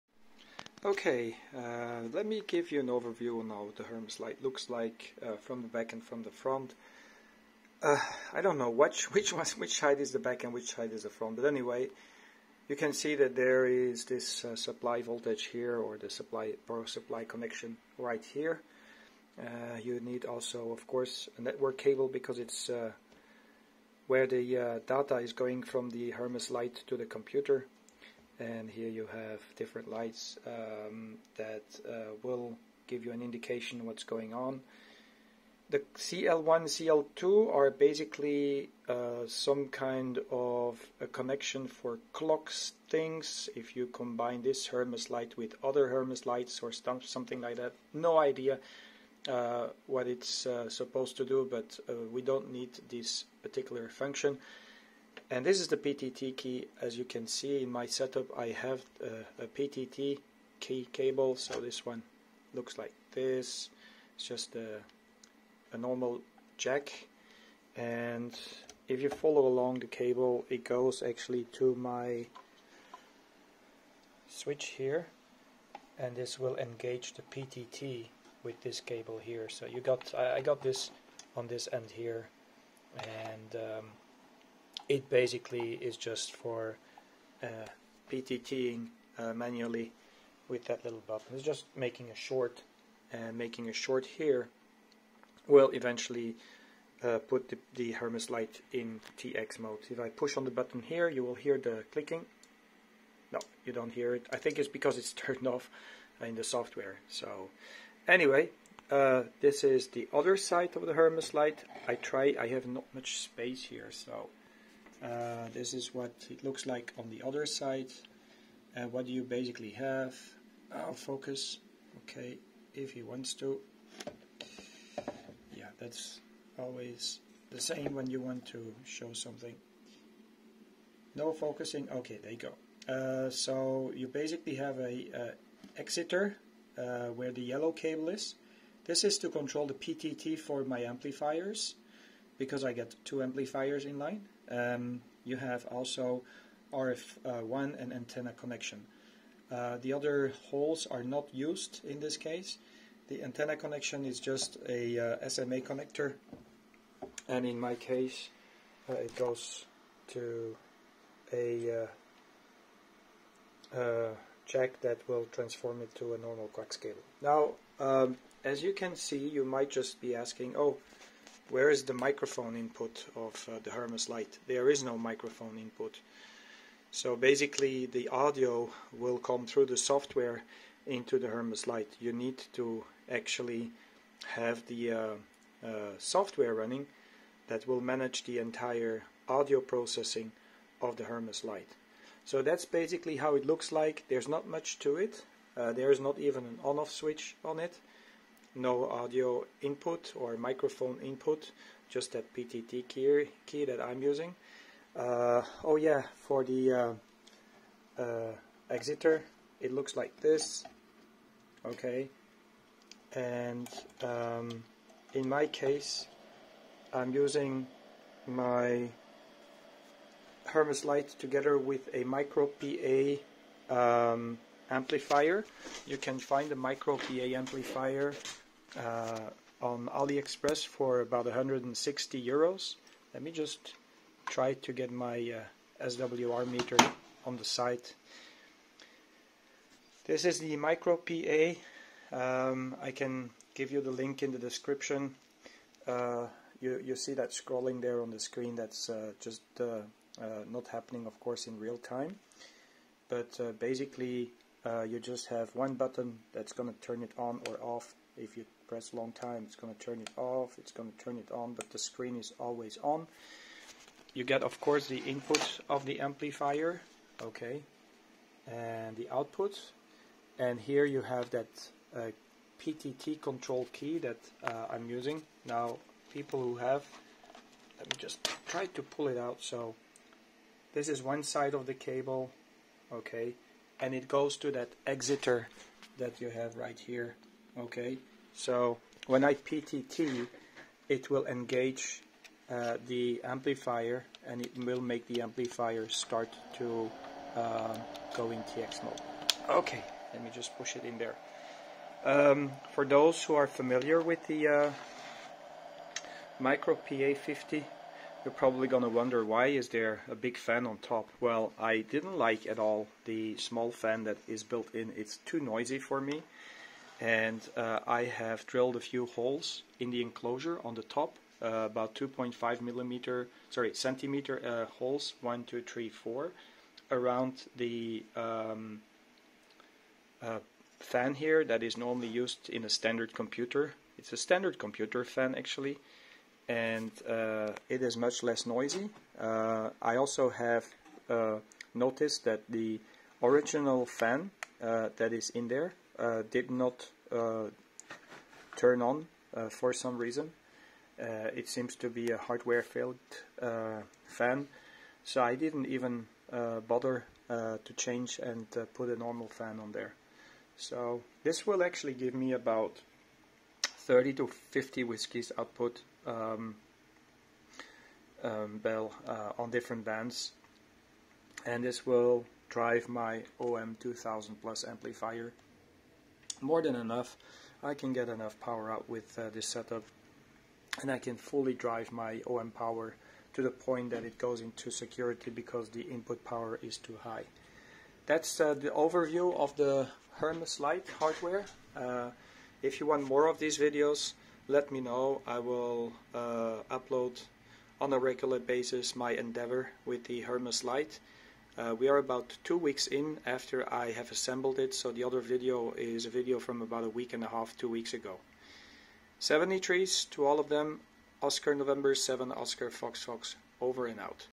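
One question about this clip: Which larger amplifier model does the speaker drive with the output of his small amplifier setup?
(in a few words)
OM2000 plus.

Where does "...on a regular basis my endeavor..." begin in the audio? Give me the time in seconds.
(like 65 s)
397 s.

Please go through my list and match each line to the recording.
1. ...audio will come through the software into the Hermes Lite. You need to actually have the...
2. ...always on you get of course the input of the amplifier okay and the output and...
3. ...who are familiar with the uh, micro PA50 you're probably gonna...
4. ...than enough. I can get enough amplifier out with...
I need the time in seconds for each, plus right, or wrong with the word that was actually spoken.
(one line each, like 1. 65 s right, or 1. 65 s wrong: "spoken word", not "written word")
1. 178 s right
2. 262 s right
3. 303 s right
4. 376 s wrong: "power", not "amplifier".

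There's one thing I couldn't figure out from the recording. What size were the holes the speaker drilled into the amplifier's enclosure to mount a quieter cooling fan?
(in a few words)
2.5 centimeters.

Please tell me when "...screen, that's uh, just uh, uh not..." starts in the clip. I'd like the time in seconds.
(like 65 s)
248 s.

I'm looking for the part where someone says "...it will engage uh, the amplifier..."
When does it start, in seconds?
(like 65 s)
290 s.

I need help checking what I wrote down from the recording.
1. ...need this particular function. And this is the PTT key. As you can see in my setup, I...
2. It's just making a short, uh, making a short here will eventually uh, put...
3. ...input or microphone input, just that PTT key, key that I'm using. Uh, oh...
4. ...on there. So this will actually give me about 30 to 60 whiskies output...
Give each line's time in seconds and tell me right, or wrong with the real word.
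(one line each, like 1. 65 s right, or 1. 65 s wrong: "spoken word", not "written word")
1. 52 s right
2. 91 s right
3. 199 s right
4. 359 s wrong: "50", not "60".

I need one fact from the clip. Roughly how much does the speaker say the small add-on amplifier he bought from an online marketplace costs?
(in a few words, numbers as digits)
160 euros.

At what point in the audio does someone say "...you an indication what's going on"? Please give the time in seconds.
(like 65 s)
33 s.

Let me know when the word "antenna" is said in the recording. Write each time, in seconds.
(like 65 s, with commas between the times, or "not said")
147 s, 153 s.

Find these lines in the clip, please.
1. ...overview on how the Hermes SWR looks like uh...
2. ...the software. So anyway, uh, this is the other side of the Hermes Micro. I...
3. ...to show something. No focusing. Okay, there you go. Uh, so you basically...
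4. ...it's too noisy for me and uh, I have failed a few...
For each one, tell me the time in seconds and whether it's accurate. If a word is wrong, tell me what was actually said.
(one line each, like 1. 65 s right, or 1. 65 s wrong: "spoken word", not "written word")
1. 2 s wrong: "Lite", not "SWR"
2. 106 s wrong: "Lite", not "Micro"
3. 128 s right
4. 314 s wrong: "drilled", not "failed".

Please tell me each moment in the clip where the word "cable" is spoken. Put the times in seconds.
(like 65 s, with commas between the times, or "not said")
21 s, 60 s, 69 s, 78 s, 137 s, 166 s, 281 s.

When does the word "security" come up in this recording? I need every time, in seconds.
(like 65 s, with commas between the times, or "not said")
384 s.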